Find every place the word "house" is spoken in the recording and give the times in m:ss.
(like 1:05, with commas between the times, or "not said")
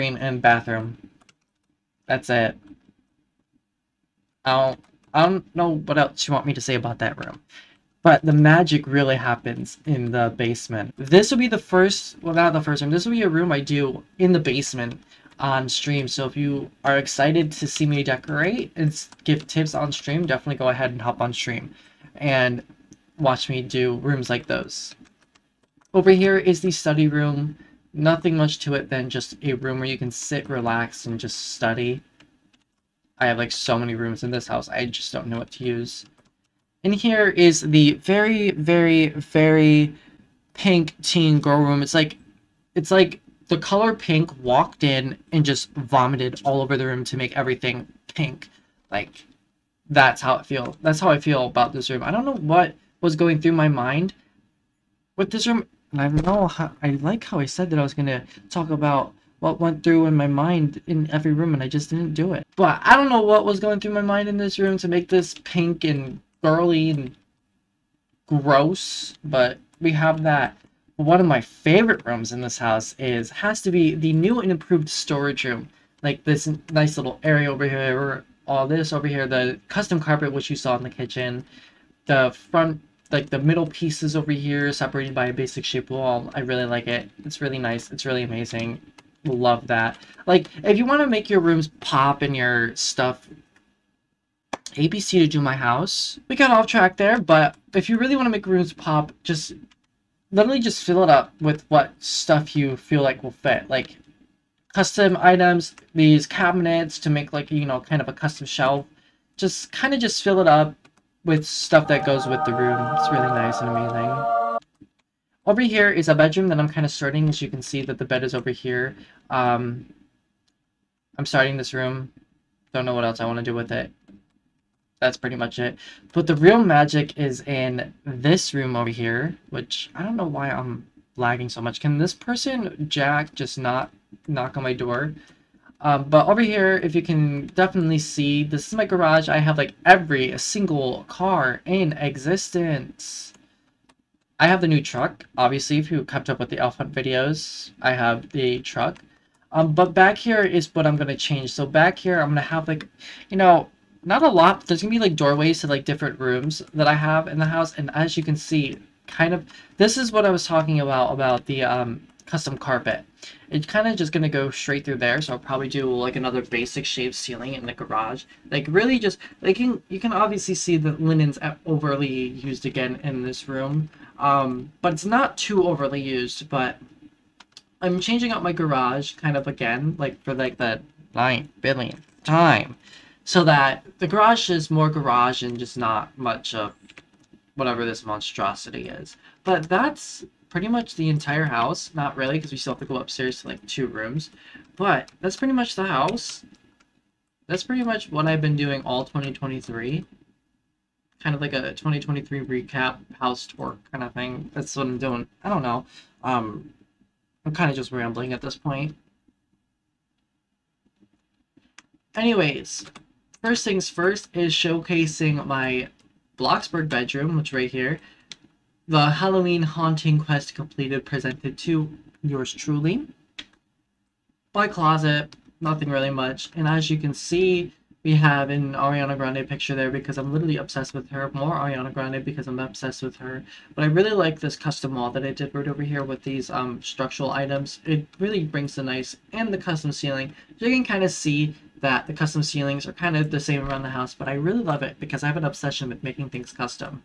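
0:34, 1:12, 1:35, 2:37, 3:11, 3:15, 3:23, 4:03.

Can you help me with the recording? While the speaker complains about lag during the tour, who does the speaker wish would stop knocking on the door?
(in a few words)
Jack.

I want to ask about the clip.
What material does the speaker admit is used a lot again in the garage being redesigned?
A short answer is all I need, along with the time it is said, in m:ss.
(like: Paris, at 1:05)
linen, at 2:50.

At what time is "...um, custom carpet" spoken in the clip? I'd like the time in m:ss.
2:41.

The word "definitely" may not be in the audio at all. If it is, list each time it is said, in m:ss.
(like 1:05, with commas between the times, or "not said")
0:20, 2:17.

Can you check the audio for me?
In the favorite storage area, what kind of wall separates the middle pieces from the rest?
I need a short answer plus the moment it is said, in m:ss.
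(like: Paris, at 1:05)
basic shape wall, at 1:25.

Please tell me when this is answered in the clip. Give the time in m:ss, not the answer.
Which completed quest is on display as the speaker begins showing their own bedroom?
3:39.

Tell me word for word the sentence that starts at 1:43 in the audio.
Like custom items, these cabinets to make like, you know, kind of a custom shelf.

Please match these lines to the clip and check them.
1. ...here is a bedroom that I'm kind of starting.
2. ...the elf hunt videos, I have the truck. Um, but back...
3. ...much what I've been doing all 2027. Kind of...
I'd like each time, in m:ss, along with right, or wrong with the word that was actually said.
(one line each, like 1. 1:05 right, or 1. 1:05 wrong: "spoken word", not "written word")
1. 1:55 right
2. 2:26 right
3. 3:17 wrong: "2023", not "2027".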